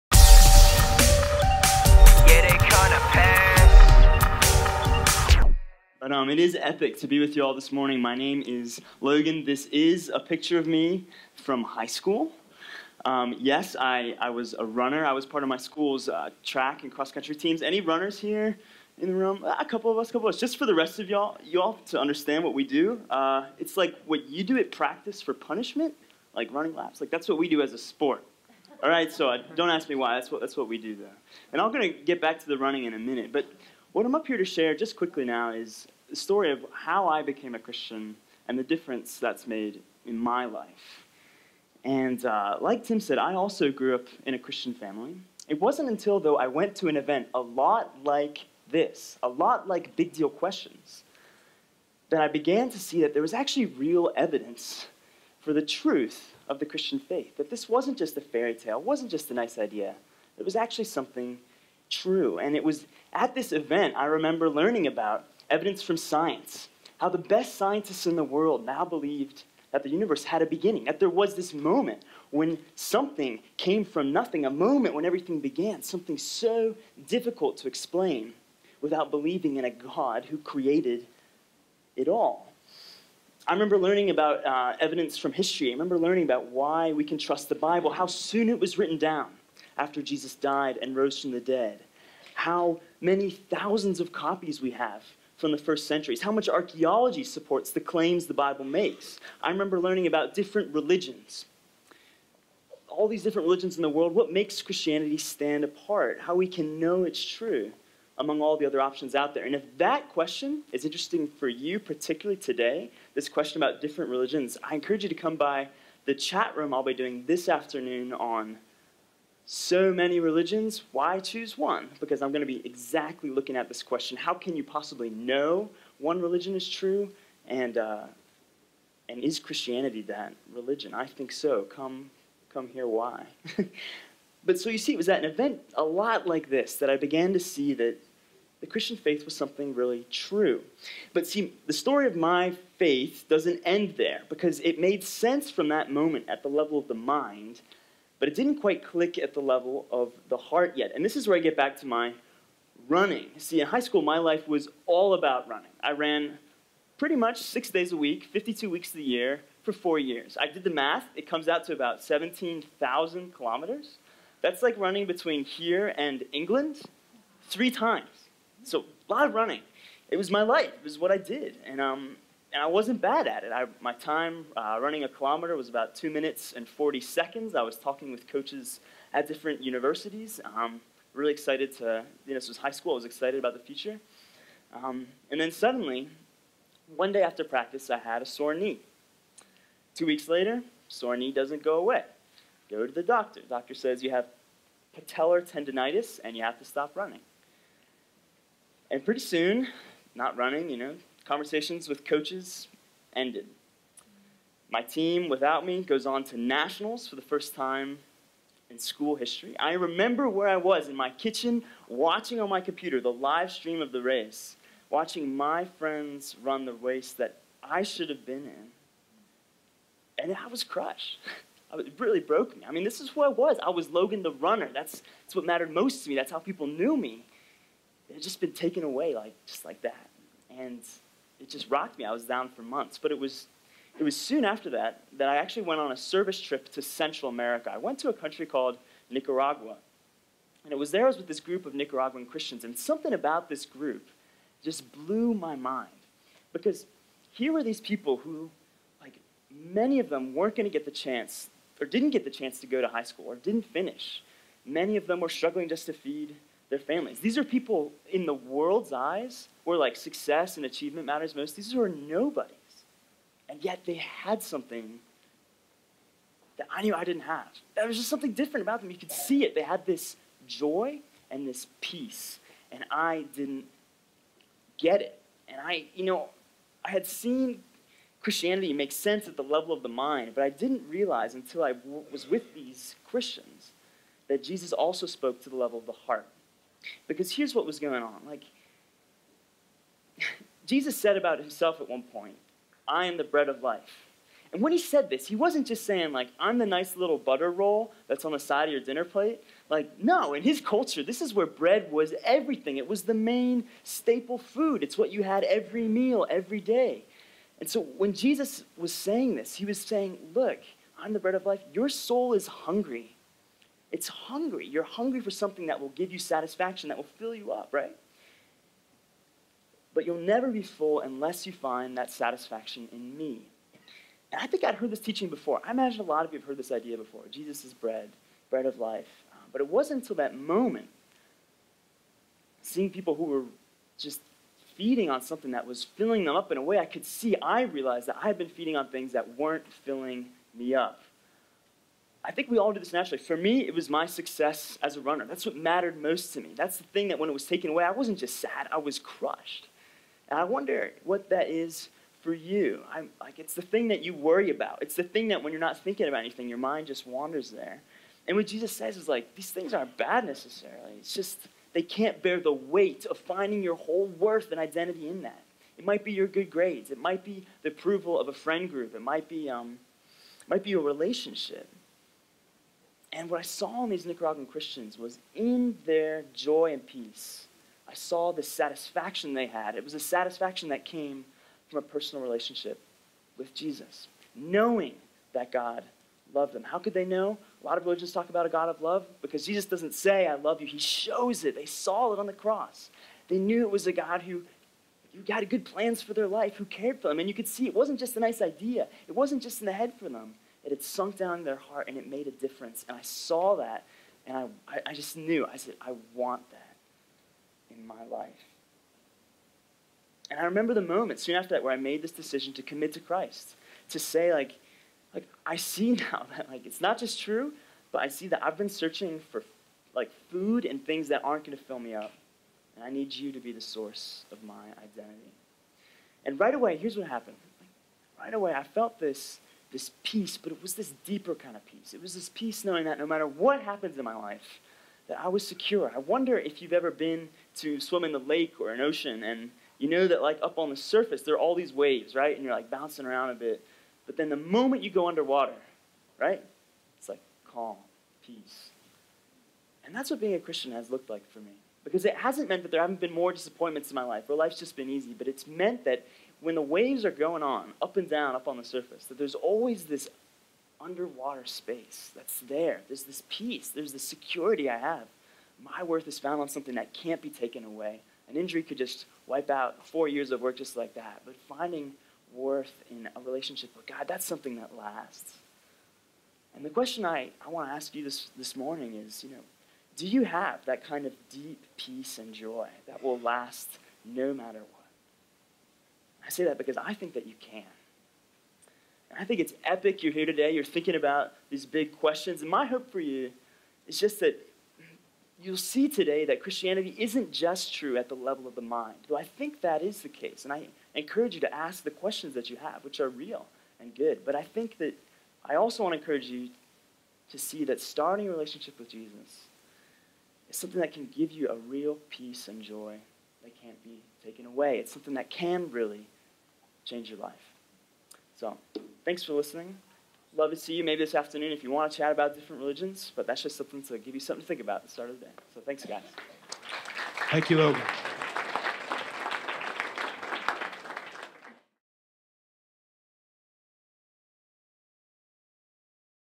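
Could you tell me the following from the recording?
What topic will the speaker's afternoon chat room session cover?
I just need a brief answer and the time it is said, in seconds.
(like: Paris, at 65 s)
So many religions, why choose one?, at 119 s.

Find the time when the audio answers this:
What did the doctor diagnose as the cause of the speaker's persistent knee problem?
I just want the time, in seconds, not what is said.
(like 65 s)
194 s.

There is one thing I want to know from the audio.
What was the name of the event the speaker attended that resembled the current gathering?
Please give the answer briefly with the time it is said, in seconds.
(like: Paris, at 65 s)
Big Deal Questions, at 49 s.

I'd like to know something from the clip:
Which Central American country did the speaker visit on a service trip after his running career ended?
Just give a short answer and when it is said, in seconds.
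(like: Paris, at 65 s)
Nicaragua, at 239 s.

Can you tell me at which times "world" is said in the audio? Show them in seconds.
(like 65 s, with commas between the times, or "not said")
68 s, 103 s, 258 s.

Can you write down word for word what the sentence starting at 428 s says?
right away, I felt this this peace, but it was this deeper kind of peace.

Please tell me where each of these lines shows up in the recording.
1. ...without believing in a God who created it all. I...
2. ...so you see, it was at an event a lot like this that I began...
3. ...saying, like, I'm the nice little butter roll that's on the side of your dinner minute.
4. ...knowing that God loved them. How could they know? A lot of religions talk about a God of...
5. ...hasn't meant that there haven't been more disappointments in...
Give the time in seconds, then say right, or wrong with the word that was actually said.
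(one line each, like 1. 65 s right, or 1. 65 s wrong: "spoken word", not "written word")
1. 78 s right
2. 134 s right
3. 295 s wrong: "plate", not "minute"
4. 384 s right
5. 452 s right.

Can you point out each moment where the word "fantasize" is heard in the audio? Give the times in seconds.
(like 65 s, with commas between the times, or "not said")
not said.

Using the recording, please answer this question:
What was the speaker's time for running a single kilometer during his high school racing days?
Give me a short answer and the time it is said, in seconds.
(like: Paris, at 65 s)
2 minutes 40 seconds, at 175 s.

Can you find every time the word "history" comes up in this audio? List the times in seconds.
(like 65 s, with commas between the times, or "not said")
85 s, 209 s.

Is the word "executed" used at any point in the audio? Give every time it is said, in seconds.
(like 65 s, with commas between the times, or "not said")
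not said.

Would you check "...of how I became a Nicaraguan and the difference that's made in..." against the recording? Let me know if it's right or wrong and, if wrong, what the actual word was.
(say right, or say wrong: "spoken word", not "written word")
wrong: "Christian", not "Nicaraguan".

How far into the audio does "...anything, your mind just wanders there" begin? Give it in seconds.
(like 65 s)
356 s.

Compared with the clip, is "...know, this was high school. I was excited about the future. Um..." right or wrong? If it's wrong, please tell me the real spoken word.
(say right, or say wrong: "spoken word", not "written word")
right.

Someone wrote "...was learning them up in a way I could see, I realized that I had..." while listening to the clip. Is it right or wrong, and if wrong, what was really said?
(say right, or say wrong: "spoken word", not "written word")
wrong: "filling", not "learning".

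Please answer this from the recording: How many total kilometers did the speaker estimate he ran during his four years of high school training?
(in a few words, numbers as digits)
17,000.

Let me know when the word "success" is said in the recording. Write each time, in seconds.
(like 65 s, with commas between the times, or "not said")
259 s, 344 s.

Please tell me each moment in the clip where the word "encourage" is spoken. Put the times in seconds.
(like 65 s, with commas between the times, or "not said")
114 s, 500 s, 505 s.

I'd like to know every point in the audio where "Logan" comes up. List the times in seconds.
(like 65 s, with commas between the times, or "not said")
9 s, 223 s, 527 s.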